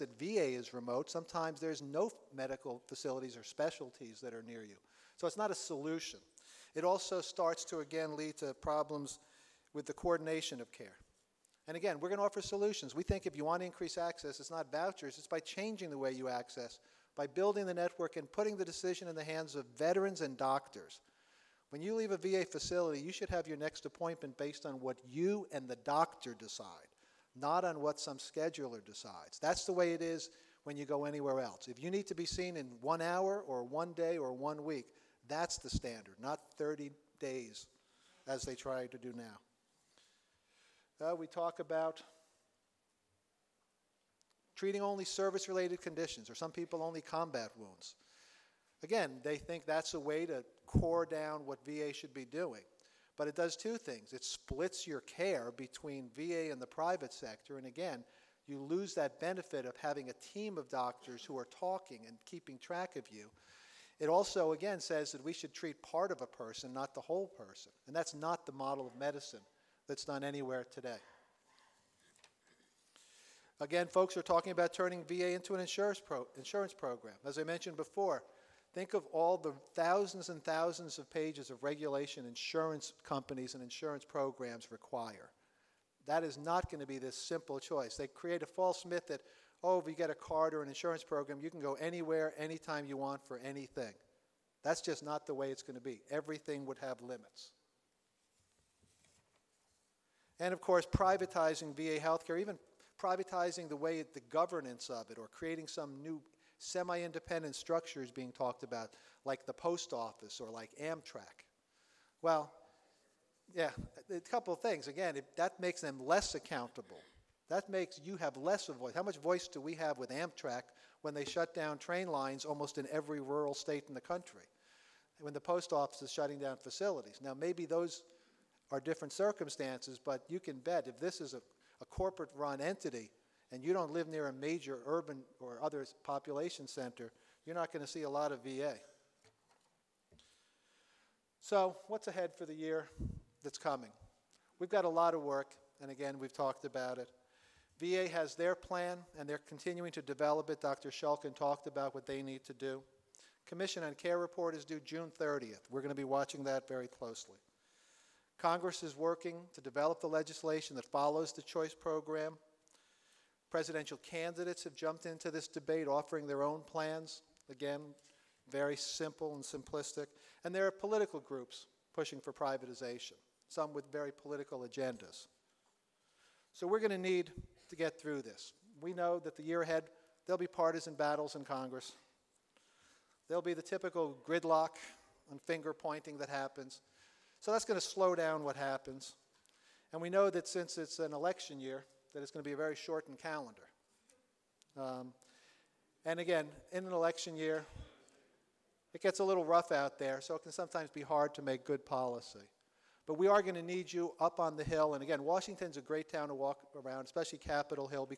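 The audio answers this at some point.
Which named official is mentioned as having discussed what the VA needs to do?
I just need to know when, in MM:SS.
02:30.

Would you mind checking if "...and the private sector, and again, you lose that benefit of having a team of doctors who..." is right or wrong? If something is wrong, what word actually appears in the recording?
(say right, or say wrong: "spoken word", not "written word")
right.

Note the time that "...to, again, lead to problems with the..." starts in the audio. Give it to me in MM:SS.
00:07.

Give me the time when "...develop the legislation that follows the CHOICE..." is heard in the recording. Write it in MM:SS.
02:39.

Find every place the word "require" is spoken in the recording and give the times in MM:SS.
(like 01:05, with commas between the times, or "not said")
01:24.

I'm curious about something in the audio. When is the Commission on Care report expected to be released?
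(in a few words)
June 30th.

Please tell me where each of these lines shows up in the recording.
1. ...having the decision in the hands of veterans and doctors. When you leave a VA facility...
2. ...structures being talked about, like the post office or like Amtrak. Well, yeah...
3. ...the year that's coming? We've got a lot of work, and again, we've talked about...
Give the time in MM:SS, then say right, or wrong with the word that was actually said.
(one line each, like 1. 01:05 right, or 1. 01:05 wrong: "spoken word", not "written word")
1. 00:18 wrong: "putting", not "having"
2. 01:47 right
3. 02:22 right.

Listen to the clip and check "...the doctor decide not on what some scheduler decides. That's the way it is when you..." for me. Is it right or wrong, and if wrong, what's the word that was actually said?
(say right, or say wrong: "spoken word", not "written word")
right.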